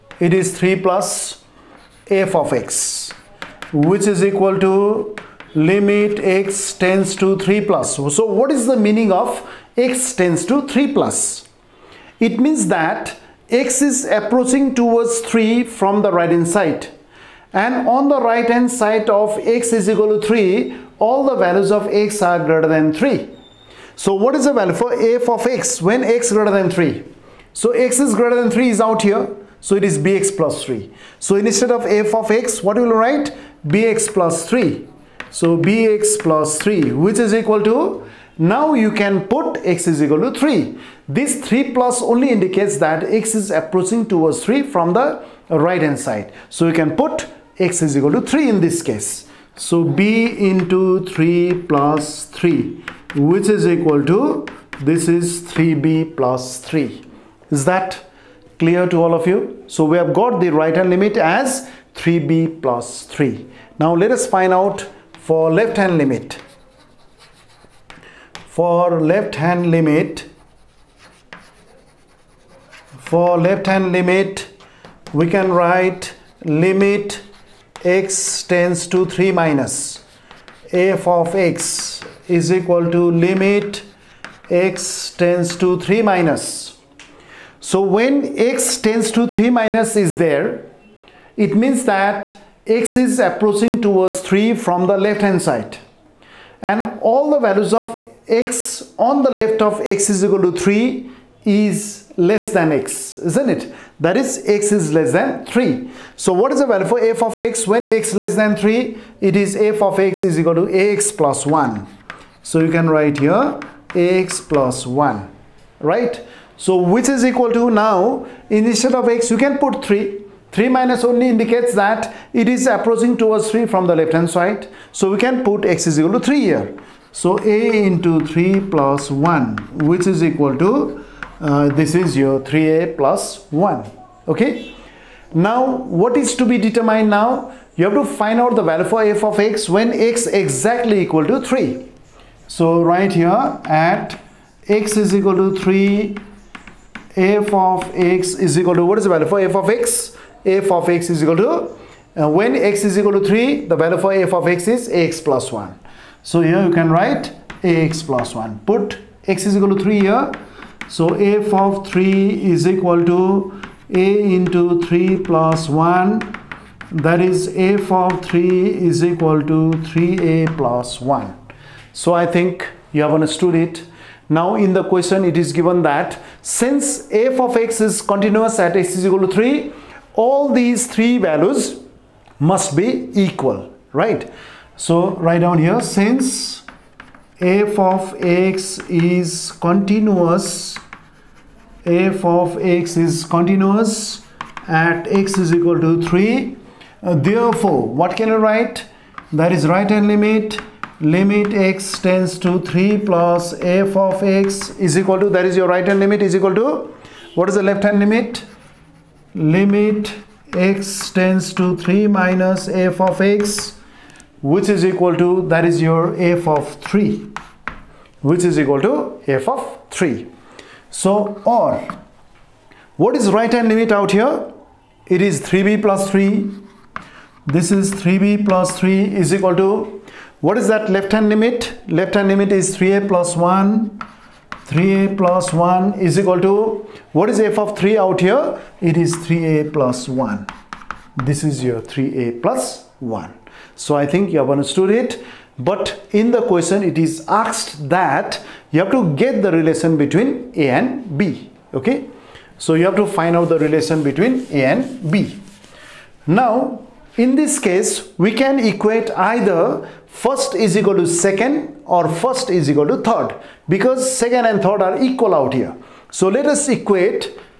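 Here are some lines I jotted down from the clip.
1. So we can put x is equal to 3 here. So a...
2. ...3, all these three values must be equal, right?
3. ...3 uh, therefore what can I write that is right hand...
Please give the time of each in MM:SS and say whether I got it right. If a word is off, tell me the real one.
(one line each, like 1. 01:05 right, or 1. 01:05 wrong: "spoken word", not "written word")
1. 02:04 right
2. 02:59 right
3. 03:16 right.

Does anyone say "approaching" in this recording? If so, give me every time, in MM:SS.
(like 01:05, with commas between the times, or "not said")
00:14, 00:43, 01:33, 02:02.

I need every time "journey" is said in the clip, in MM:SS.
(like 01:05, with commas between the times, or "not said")
not said.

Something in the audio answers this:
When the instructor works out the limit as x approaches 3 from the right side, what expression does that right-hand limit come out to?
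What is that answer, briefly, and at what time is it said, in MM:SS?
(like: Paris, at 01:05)
3b + 3, at 00:55.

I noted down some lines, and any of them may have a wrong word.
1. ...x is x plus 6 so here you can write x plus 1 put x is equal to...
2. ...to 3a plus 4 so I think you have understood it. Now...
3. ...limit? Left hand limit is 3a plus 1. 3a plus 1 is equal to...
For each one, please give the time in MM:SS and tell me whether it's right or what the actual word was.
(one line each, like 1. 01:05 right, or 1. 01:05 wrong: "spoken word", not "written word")
1. 02:34 wrong: "1", not "6"
2. 02:49 wrong: "1", not "4"
3. 03:51 right.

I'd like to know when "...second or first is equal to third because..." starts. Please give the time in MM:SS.
04:21.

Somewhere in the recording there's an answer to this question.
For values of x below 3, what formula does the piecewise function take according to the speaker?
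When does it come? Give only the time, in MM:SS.
01:49.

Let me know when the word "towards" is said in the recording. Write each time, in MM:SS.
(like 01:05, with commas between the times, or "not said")
00:14, 00:44, 01:33, 02:03.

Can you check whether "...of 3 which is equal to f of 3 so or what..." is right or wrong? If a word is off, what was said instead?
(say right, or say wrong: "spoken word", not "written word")
right.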